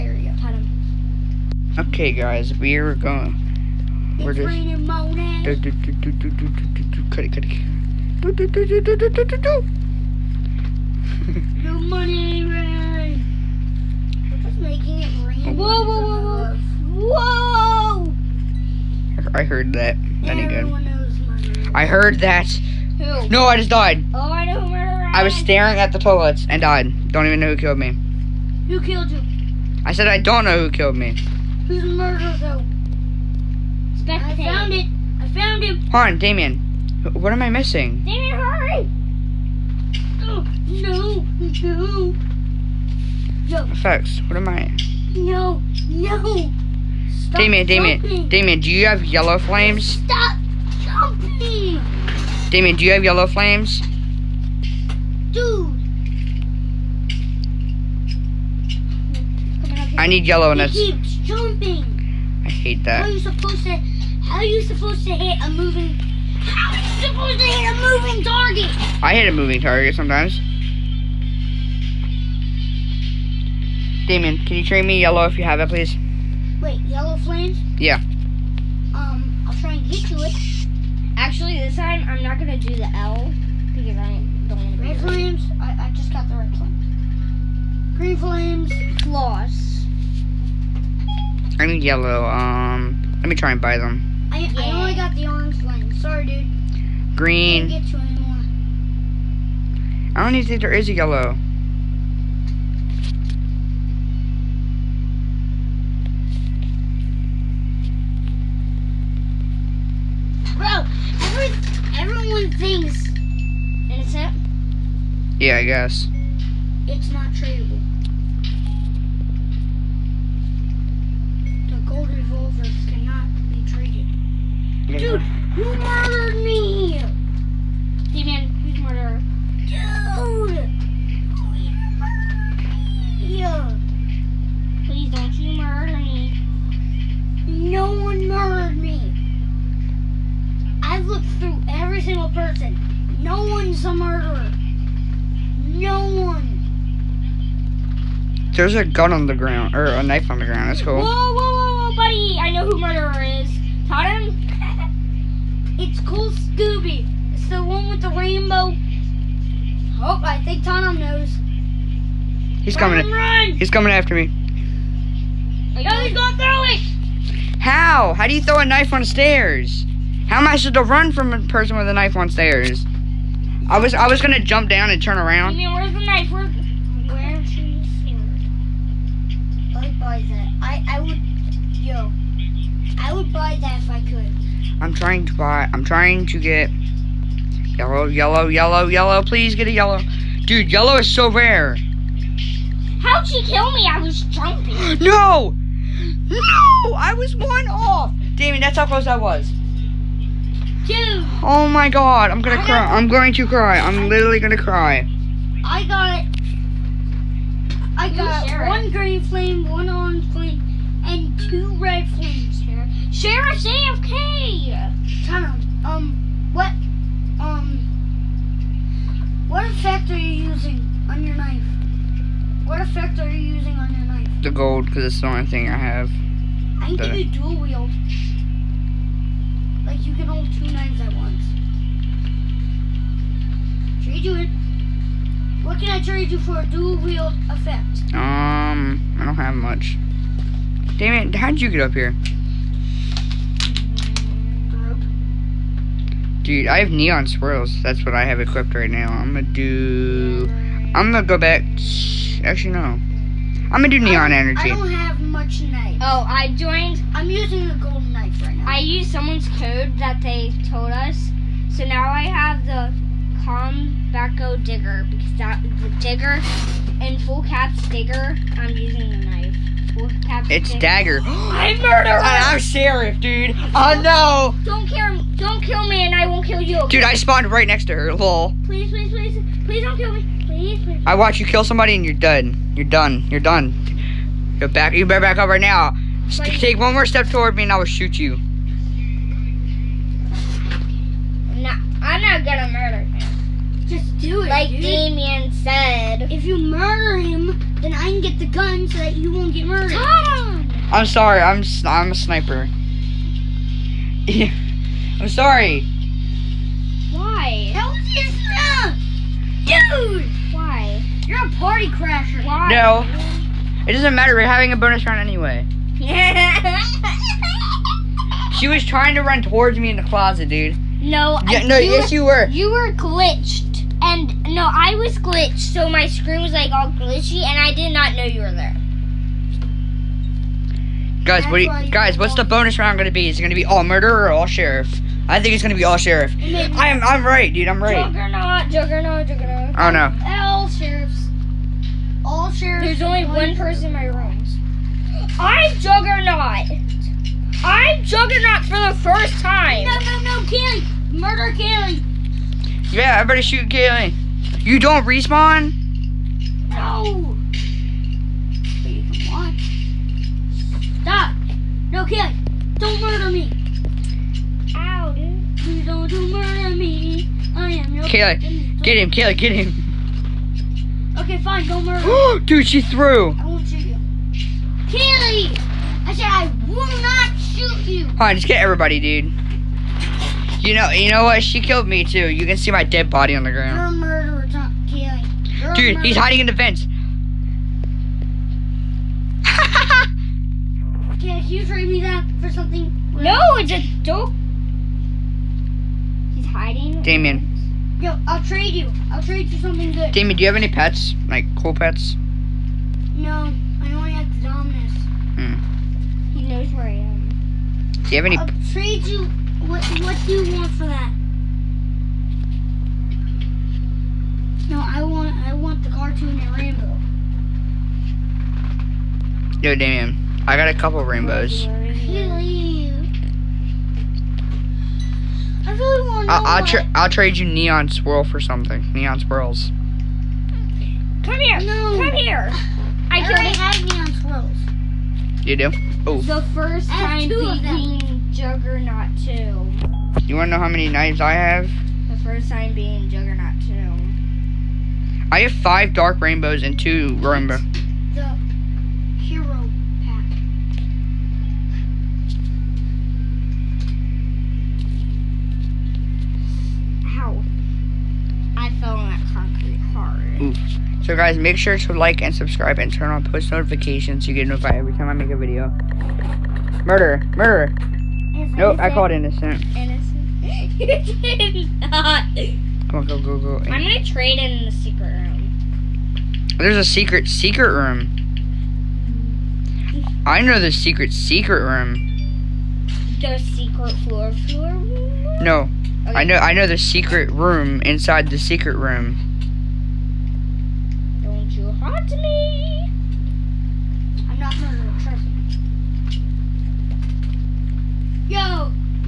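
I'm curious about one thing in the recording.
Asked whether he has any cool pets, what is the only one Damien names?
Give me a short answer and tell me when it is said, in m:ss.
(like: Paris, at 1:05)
Dominus, at 6:44.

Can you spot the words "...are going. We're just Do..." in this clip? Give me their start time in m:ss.
0:02.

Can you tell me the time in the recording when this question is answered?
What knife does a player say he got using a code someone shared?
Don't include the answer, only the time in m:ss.
4:23.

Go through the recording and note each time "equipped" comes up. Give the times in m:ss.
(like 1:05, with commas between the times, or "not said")
4:08.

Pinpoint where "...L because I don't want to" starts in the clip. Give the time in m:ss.
1:22.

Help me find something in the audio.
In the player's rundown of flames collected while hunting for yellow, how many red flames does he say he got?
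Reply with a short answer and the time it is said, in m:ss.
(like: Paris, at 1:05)
2, at 3:31.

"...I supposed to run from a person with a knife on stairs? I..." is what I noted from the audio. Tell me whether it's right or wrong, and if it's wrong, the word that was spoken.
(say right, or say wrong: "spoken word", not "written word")
right.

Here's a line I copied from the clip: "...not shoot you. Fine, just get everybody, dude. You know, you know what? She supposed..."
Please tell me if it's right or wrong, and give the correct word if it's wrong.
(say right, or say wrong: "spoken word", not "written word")
wrong: "killed", not "supposed".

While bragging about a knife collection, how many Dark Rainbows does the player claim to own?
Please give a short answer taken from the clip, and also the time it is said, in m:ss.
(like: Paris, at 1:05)
5, at 7:25.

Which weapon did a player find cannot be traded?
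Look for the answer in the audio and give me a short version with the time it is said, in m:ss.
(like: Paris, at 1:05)
gold revolver, at 2:01.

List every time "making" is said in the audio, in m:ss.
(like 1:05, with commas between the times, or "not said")
0:14.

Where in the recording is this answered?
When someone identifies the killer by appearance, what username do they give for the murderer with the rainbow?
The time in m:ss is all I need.
2:35.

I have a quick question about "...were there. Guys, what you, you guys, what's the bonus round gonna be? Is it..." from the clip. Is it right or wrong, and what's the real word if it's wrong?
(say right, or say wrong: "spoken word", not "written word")
right.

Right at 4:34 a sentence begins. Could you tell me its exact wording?
Don't kill, don't kill me, and I won't kill you.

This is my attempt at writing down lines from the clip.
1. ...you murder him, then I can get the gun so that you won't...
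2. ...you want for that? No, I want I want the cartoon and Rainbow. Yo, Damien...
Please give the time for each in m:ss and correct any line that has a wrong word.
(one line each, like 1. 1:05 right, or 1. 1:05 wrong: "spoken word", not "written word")
1. 4:56 right
2. 6:50 right.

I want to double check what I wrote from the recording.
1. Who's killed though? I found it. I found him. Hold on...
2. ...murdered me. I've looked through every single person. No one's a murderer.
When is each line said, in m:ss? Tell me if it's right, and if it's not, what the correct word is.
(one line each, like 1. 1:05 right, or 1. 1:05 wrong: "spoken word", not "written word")
1. 0:31 wrong: "murdered", not "killed"
2. 2:18 right.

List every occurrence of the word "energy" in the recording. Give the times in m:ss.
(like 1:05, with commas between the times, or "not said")
4:14.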